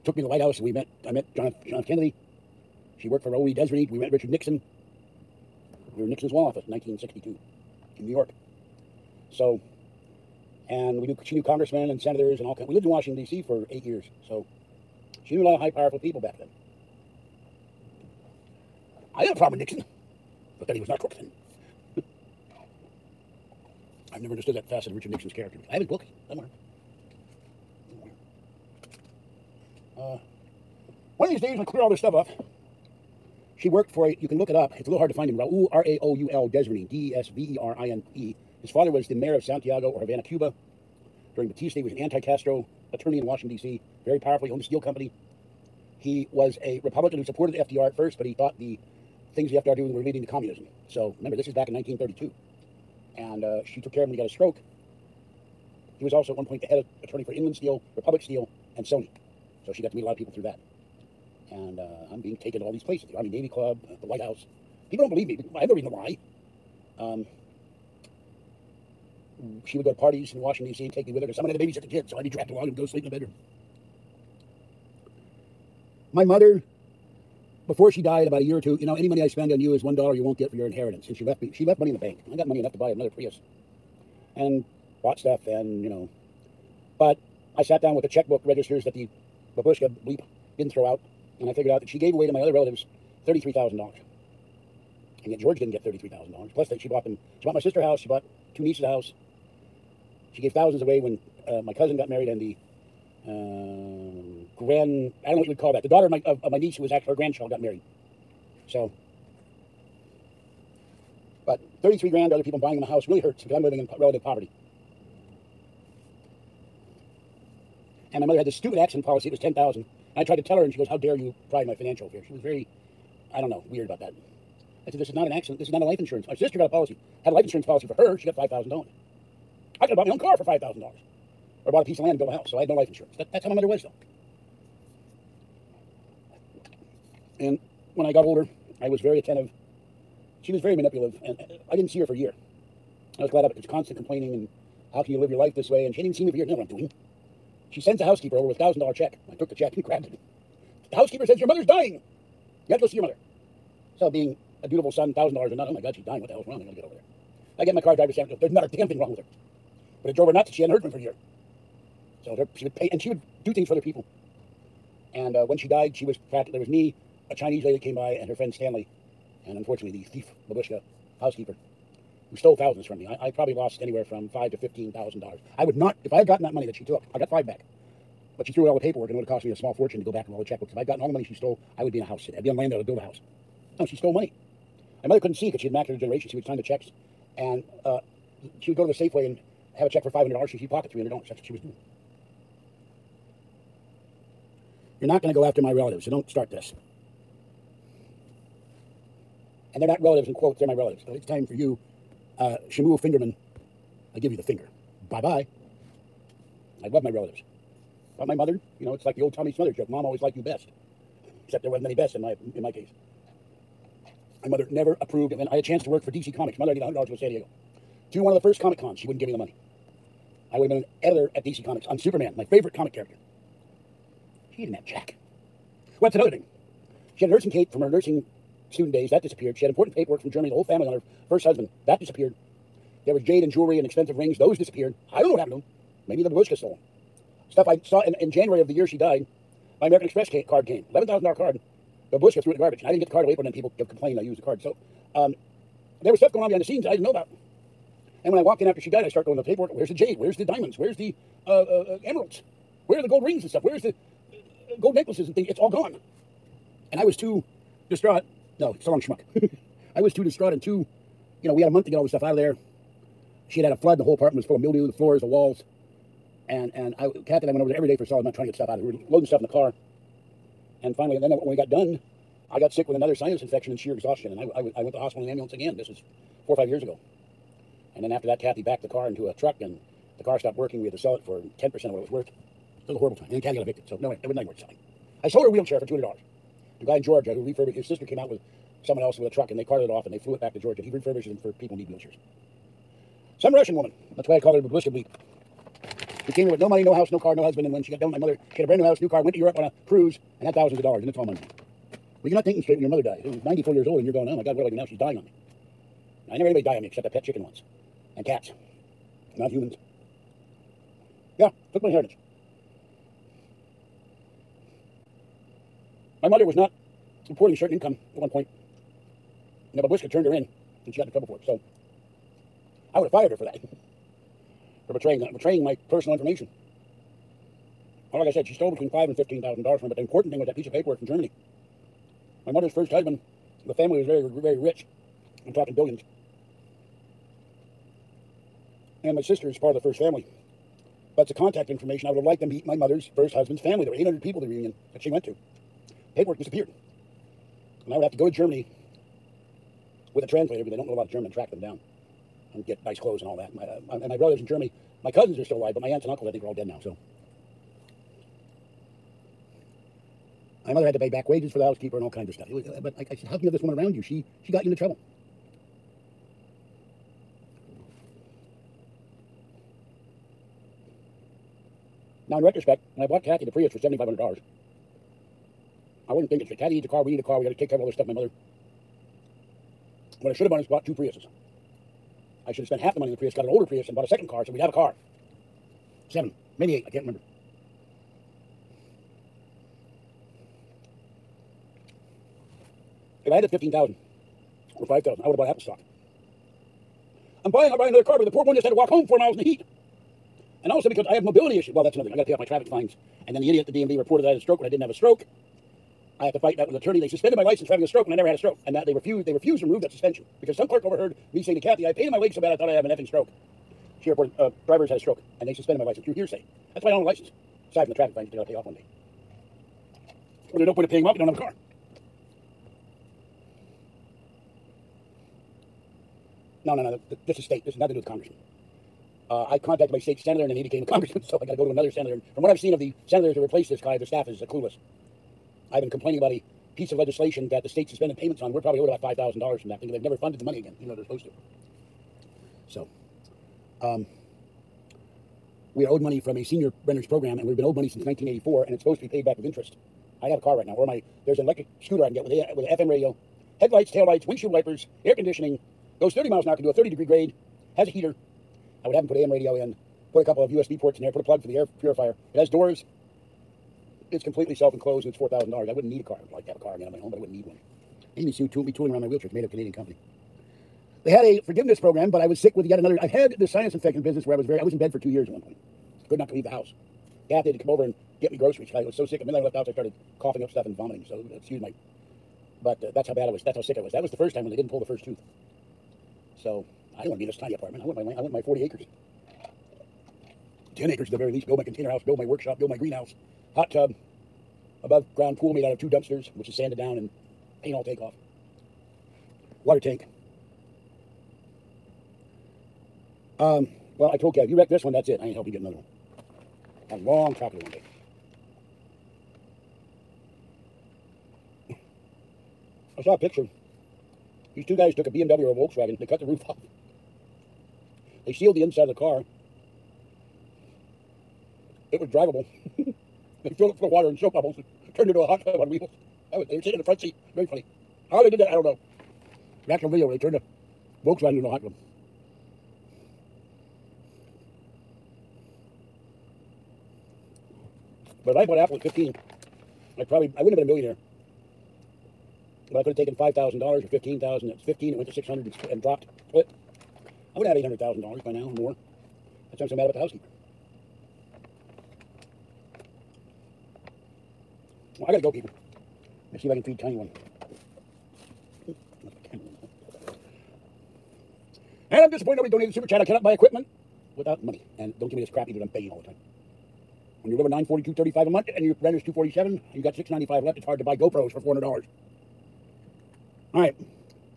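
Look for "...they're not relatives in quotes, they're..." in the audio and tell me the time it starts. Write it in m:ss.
3:19.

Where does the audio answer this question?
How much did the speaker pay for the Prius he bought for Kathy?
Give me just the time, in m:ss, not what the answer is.
6:13.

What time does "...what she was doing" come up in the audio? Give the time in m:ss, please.
3:11.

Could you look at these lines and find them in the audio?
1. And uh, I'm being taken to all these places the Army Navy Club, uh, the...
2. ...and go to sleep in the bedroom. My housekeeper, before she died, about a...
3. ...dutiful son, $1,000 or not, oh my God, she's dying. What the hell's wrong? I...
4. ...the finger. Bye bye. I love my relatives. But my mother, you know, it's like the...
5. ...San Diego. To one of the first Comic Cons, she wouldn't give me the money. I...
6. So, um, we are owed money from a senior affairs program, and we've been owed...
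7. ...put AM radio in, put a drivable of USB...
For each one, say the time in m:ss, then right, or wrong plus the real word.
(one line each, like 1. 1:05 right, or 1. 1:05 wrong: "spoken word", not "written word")
1. 1:01 right
2. 1:12 wrong: "mother", not "housekeeper"
3. 2:34 right
4. 3:24 right
5. 3:37 right
6. 7:22 wrong: "renters", not "affairs"
7. 7:39 wrong: "couple", not "drivable".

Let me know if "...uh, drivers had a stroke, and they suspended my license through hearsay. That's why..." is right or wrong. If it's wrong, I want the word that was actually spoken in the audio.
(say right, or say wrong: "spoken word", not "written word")
right.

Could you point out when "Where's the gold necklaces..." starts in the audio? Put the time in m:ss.
4:13.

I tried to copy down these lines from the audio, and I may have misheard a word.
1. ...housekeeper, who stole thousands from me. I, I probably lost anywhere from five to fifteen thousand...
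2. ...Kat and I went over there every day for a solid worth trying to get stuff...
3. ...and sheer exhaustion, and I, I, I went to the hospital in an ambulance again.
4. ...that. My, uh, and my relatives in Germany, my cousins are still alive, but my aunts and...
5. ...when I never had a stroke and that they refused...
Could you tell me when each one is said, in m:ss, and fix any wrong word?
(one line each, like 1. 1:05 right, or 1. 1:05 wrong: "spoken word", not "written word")
1. 2:51 right
2. 4:27 wrong: "month", not "worth"
3. 4:33 right
4. 5:53 right
5. 6:48 right.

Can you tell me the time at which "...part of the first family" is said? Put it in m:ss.
5:39.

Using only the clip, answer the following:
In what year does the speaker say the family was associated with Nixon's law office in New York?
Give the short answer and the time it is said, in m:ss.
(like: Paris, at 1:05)
1962, at 0:06.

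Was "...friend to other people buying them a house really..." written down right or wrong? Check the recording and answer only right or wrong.
wrong.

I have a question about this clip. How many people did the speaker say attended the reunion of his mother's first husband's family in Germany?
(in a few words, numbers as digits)
800.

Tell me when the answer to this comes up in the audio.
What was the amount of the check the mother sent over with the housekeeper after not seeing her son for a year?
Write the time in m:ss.
2:28.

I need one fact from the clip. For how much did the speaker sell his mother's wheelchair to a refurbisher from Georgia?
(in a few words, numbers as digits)
$200.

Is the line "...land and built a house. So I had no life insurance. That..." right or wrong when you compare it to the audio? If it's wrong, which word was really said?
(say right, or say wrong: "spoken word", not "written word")
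right.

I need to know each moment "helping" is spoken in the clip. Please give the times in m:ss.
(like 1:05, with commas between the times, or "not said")
8:25.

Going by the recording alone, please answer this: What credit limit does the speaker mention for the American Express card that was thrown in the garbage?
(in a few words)
$11,000.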